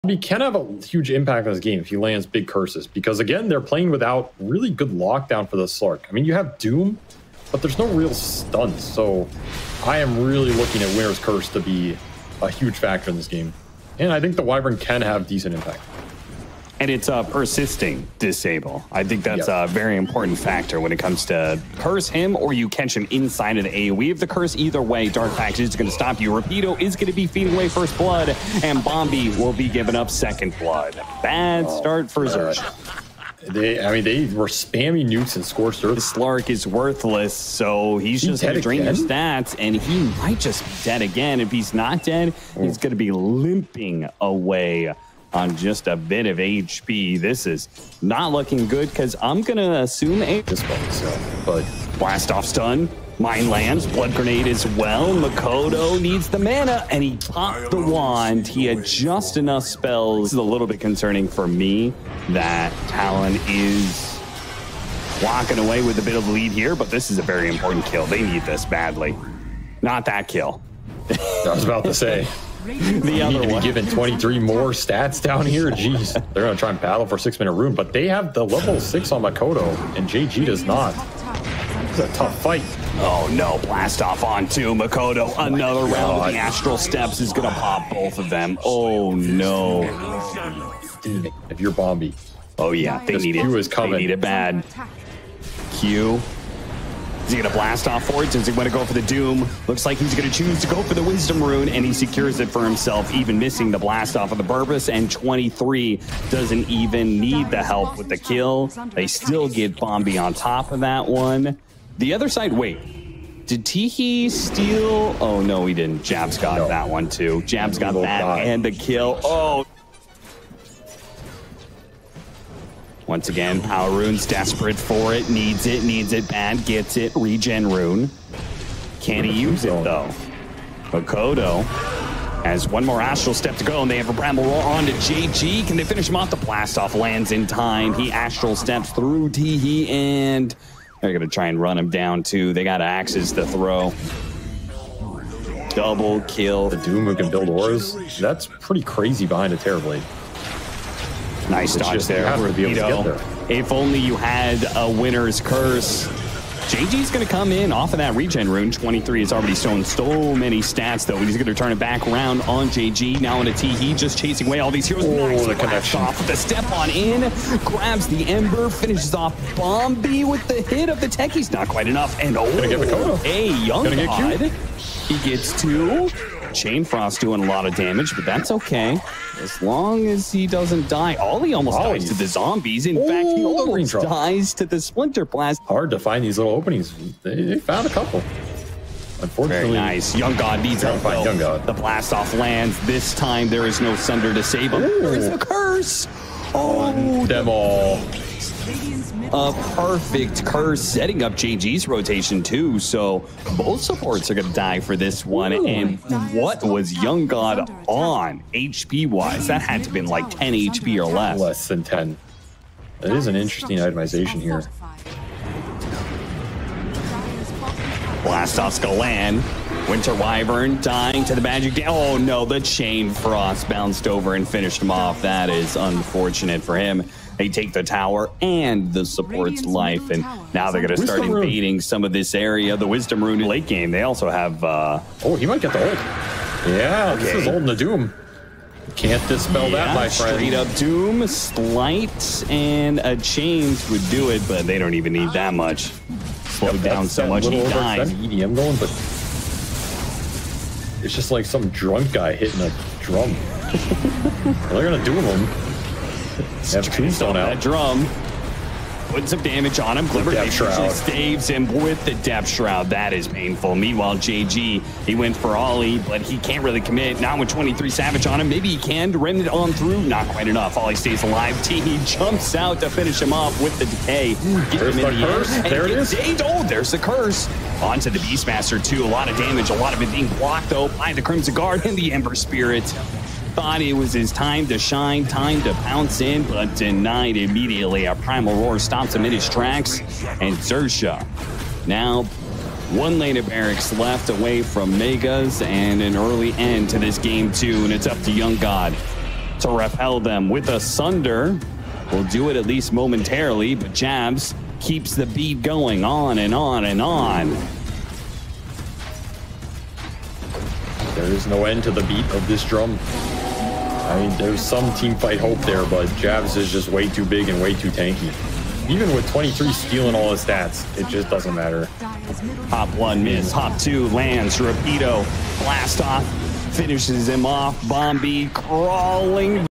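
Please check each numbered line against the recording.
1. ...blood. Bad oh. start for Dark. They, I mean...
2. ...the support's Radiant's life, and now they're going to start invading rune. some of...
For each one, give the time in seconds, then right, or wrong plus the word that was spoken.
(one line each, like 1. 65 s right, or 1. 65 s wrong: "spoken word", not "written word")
1. 30 s wrong: "Zerg", not "Dark"
2. 228 s right.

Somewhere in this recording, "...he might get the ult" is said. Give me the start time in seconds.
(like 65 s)
235 s.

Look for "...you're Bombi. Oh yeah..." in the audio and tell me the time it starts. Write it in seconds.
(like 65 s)
91 s.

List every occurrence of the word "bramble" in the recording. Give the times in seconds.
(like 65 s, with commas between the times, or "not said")
134 s.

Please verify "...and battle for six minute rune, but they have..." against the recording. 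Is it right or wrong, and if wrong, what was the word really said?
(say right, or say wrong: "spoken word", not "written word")
right.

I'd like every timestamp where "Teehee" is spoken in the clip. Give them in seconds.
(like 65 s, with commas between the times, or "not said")
113 s, 139 s.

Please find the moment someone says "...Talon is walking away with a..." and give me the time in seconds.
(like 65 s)
62 s.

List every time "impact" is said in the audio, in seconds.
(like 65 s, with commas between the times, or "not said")
1 s, 15 s.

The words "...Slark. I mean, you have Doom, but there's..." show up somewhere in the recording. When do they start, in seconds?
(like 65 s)
5 s.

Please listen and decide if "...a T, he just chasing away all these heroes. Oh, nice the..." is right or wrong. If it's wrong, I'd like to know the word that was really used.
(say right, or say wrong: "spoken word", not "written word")
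right.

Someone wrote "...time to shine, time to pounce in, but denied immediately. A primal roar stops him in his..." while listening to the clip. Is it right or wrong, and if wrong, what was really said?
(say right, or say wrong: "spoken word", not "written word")
right.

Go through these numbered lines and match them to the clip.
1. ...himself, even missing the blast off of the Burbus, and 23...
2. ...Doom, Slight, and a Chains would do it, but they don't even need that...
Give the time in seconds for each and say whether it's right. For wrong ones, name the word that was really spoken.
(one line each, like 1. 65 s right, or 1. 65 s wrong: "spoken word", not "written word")
1. 102 s right
2. 240 s right.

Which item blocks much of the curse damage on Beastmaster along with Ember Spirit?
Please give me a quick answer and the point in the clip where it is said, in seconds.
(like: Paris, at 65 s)
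Crimson Guard, at 281 s.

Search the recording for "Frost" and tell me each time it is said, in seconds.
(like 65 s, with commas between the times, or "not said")
176 s, 223 s.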